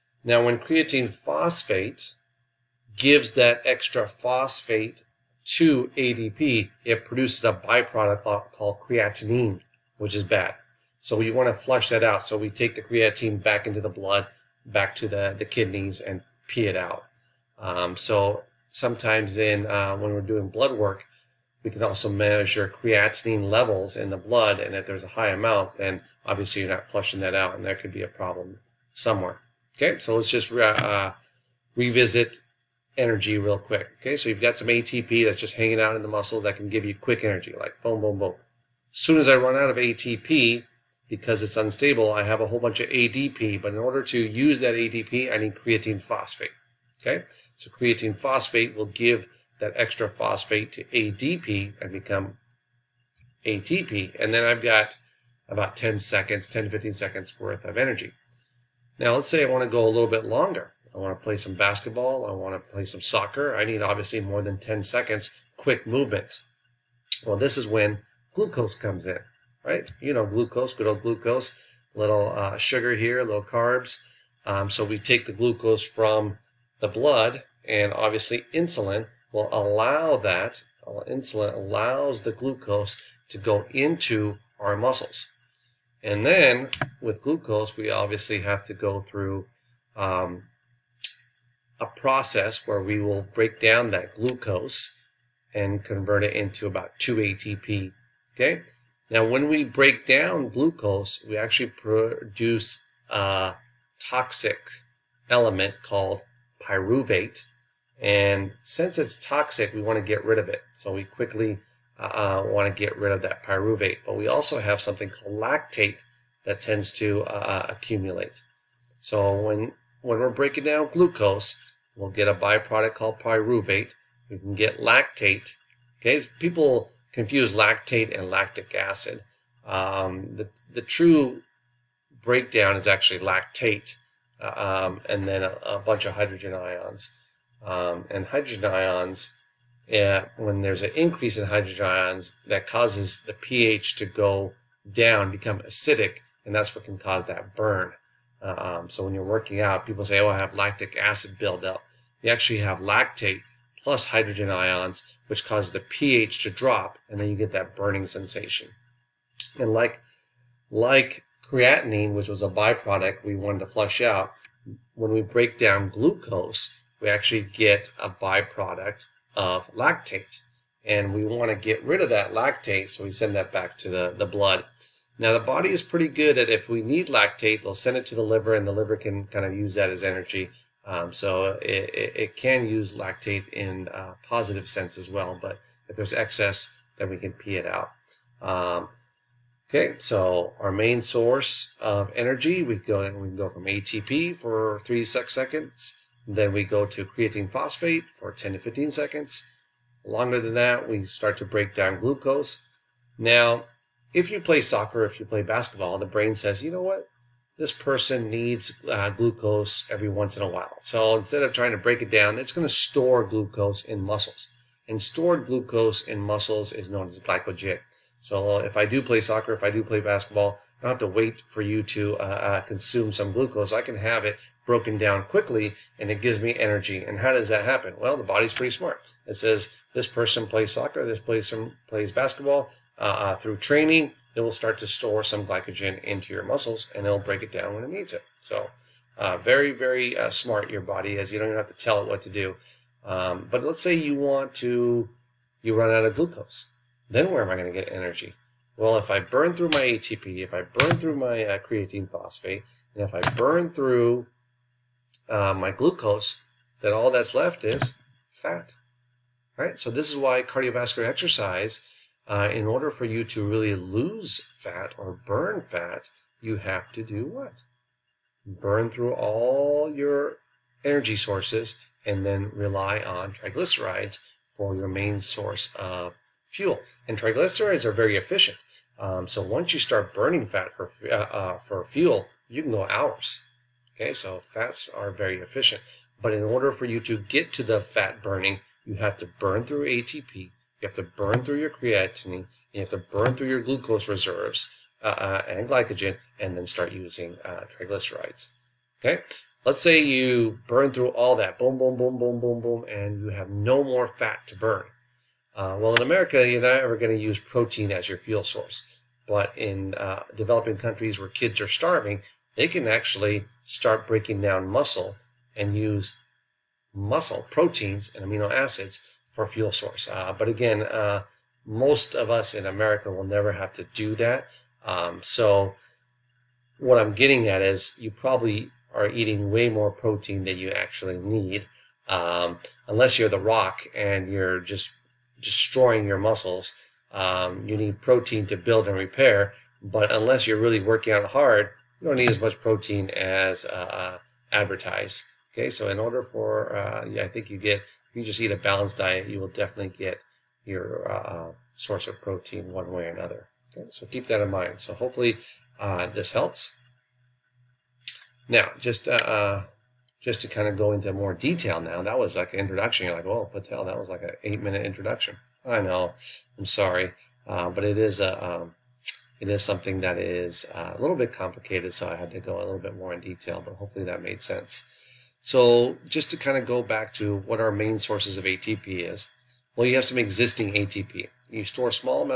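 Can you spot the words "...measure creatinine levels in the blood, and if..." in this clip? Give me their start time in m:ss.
0:22.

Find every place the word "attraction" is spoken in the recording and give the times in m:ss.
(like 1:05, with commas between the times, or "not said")
not said.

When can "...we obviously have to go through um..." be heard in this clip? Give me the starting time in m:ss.
1:27.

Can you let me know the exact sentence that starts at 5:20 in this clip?
Uh, but again, uh, most of us in America will never have to do that.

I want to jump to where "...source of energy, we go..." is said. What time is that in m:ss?
3:11.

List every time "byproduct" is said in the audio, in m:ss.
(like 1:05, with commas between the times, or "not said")
0:07, 2:02, 2:42, 2:48.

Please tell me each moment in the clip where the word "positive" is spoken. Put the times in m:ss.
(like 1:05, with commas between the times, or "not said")
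3:04.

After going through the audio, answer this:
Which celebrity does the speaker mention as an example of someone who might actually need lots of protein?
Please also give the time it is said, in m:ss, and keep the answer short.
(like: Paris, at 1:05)
The Rock, at 5:33.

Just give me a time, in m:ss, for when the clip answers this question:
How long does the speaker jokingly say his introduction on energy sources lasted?
6:04.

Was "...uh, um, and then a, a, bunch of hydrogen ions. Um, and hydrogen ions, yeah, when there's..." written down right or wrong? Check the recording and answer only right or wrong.
right.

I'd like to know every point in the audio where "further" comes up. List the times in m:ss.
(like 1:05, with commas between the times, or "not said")
not said.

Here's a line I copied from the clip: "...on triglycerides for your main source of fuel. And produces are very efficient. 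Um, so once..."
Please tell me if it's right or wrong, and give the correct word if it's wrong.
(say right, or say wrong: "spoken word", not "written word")
wrong: "triglycerides", not "produces".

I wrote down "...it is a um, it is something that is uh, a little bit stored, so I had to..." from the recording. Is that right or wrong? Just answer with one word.
wrong.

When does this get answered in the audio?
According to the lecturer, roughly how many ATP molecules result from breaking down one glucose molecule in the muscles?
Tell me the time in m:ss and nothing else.
1:37.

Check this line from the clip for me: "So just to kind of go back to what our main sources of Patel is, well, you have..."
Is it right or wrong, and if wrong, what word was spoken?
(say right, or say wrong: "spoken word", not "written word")
wrong: "ATP", not "Patel".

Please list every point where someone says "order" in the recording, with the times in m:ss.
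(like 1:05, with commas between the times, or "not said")
0:43, 4:22, 4:46, 5:45.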